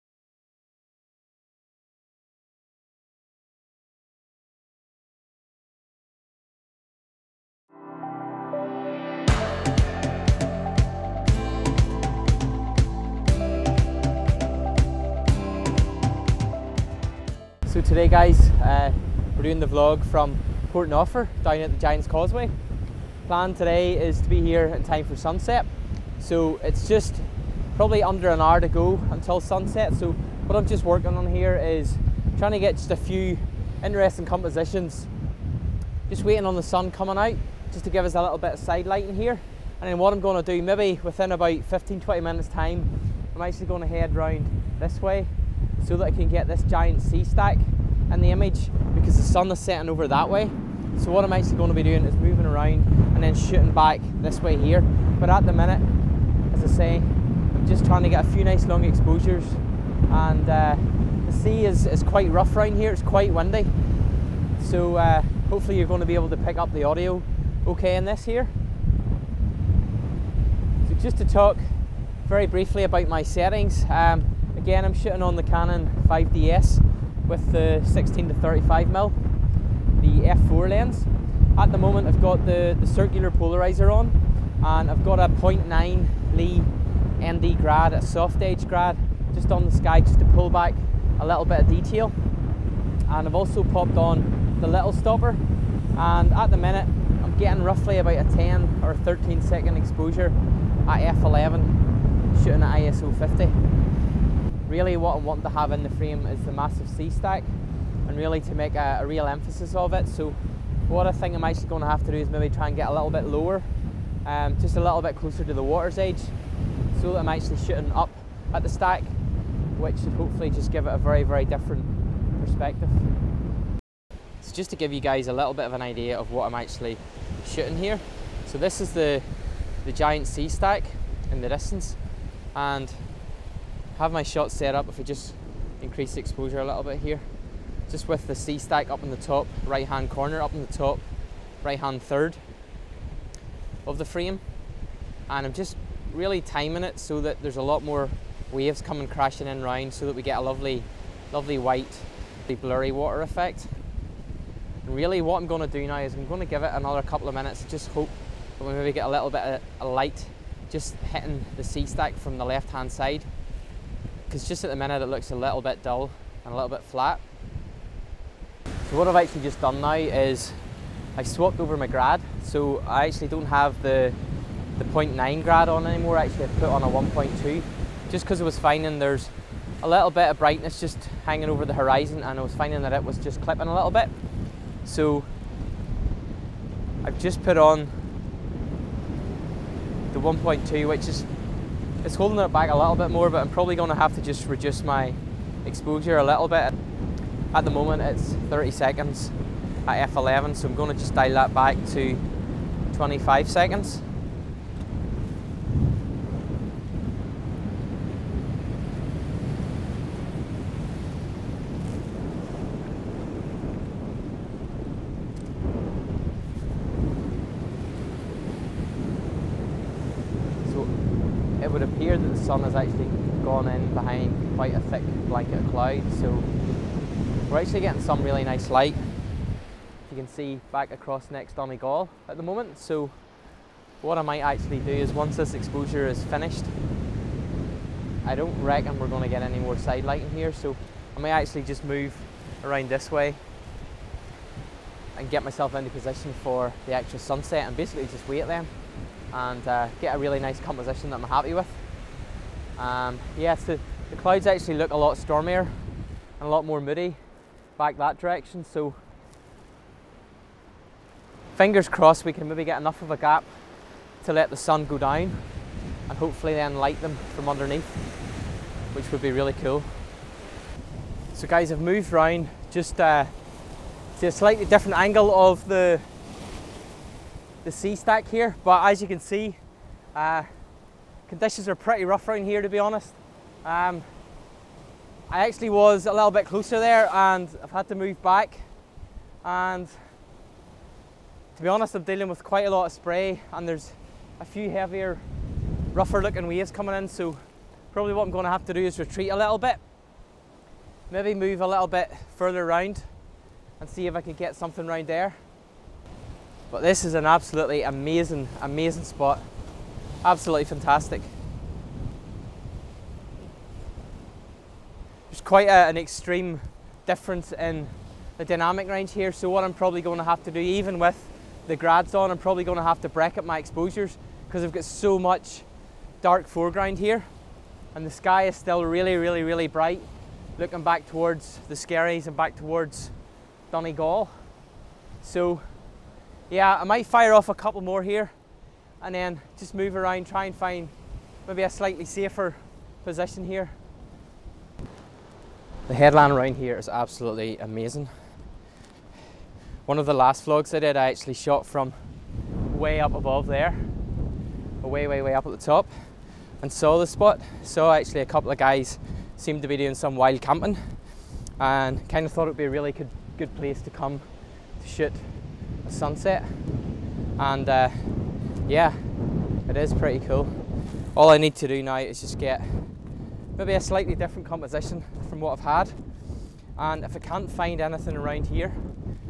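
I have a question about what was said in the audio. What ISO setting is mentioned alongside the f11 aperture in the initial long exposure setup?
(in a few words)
ISO 50.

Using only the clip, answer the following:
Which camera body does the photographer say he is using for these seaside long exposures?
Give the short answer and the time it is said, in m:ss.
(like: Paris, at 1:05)
Canon 5DS, at 1:15.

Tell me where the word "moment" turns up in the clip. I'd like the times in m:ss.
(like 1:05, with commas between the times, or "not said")
1:21, 3:17, 3:52.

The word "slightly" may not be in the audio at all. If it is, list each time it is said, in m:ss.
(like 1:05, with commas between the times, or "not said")
4:34, 5:41, 6:13.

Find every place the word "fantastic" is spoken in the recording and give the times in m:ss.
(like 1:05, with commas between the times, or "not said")
5:10.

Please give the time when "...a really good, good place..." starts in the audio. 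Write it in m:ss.
6:02.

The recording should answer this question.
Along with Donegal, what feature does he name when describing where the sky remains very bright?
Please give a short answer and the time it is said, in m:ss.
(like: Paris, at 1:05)
the Skerries, at 5:31.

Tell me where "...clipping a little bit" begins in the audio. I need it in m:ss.
3:03.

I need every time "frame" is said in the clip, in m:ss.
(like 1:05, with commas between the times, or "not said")
1:45, 2:24.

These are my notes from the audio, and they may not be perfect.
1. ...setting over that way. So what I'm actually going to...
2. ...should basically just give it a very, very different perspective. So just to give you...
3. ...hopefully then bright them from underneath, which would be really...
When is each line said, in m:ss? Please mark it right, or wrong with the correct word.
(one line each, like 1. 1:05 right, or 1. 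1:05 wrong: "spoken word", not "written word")
1. 0:49 right
2. 2:00 wrong: "hopefully", not "basically"
3. 4:26 wrong: "light", not "bright".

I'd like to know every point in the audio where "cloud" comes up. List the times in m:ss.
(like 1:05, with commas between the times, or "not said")
3:45, 4:14.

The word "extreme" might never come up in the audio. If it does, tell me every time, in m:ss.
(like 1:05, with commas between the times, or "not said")
5:15.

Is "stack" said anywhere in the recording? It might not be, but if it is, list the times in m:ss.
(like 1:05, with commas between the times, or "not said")
0:47, 1:46, 1:58, 2:10, 2:18, 2:41, 4:37.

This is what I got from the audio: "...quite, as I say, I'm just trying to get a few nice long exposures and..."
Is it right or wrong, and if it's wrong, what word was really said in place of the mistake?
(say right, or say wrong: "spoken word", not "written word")
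wrong: "minute", not "quite".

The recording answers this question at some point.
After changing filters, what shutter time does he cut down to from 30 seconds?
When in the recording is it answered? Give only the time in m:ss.
3:22.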